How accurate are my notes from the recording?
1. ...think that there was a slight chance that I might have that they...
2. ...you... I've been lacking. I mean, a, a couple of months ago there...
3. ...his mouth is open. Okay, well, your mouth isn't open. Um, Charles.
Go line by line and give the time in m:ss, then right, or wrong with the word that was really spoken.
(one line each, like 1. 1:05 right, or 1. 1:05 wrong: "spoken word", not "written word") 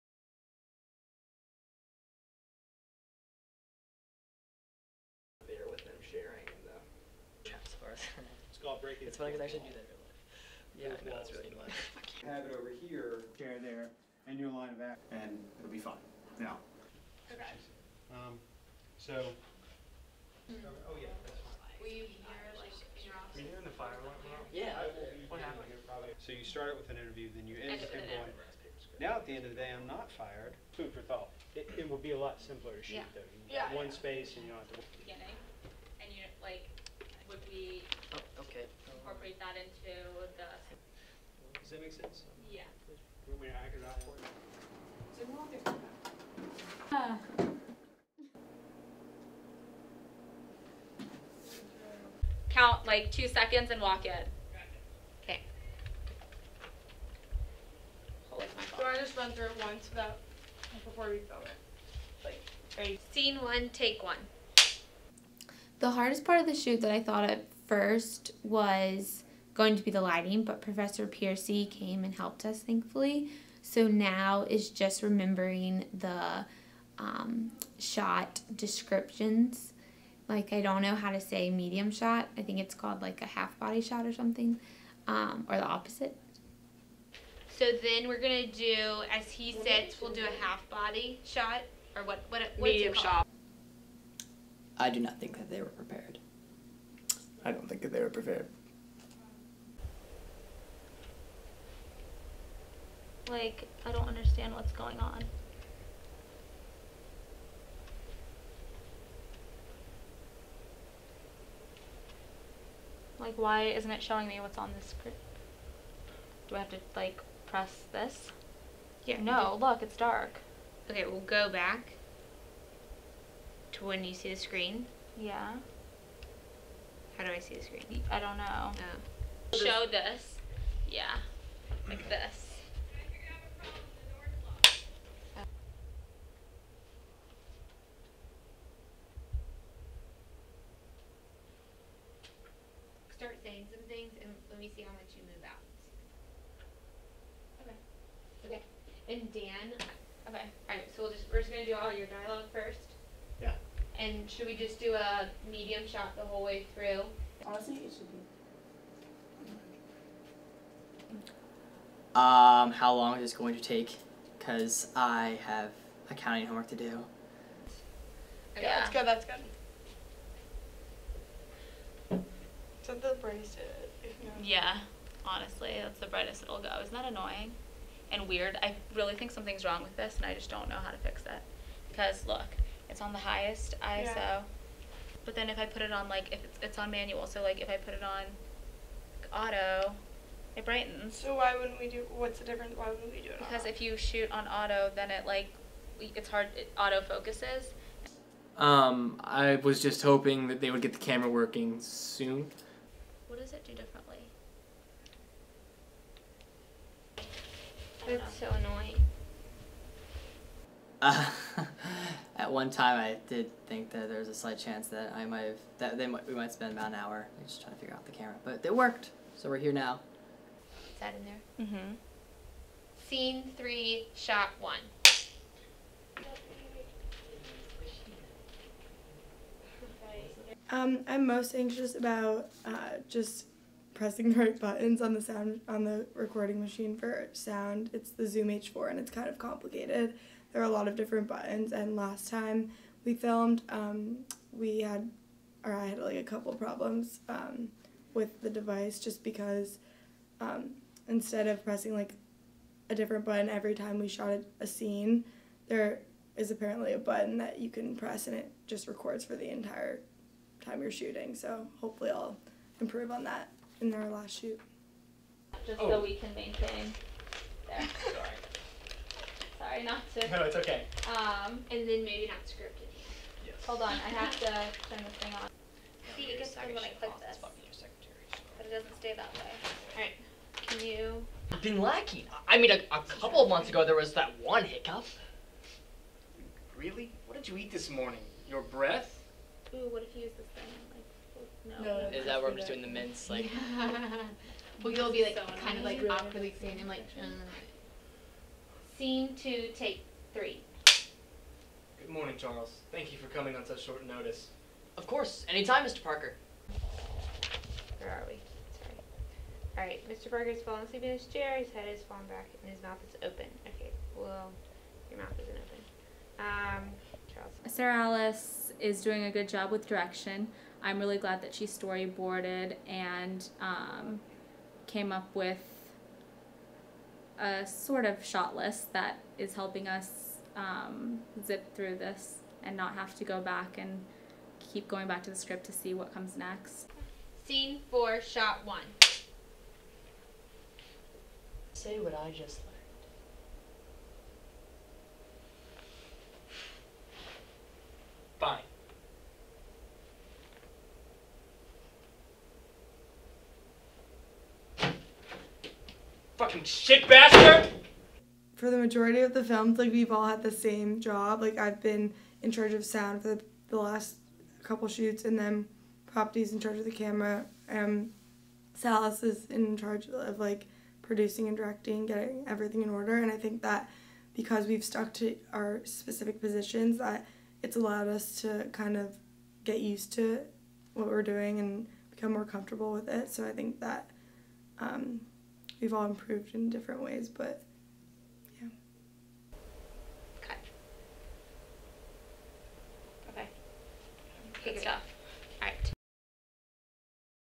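1. 3:33 right
2. 4:40 right
3. 5:12 right.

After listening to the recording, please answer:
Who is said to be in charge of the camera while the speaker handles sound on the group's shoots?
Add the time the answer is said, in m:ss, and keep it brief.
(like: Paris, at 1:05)
Poppy, at 6:06.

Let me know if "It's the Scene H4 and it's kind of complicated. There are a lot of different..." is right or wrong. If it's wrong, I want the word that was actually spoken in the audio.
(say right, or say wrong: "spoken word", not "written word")
wrong: "Zoom", not "Scene".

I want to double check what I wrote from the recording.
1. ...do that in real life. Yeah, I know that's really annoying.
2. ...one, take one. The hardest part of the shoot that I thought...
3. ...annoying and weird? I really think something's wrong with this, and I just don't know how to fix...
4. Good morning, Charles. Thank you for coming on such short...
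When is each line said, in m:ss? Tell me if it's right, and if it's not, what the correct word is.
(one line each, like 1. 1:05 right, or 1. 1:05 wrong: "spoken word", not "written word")
1. 0:09 right
2. 1:03 right
3. 2:57 right
4. 5:01 right.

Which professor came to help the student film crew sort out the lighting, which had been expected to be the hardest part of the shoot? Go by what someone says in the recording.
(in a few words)
Professor Piercy.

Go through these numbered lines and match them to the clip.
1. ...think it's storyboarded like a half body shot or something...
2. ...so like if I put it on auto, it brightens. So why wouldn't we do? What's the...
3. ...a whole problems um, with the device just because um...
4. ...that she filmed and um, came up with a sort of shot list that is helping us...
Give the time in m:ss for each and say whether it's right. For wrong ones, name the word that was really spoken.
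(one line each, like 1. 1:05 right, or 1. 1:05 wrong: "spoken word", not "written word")
1. 1:22 wrong: "called", not "storyboarded"
2. 3:07 right
3. 4:06 wrong: "couple", not "whole"
4. 5:21 wrong: "storyboarded", not "filmed".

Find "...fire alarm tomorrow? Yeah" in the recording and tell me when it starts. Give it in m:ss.
0:23.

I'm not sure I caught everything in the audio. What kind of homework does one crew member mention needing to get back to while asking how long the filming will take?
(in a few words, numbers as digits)
Accounting.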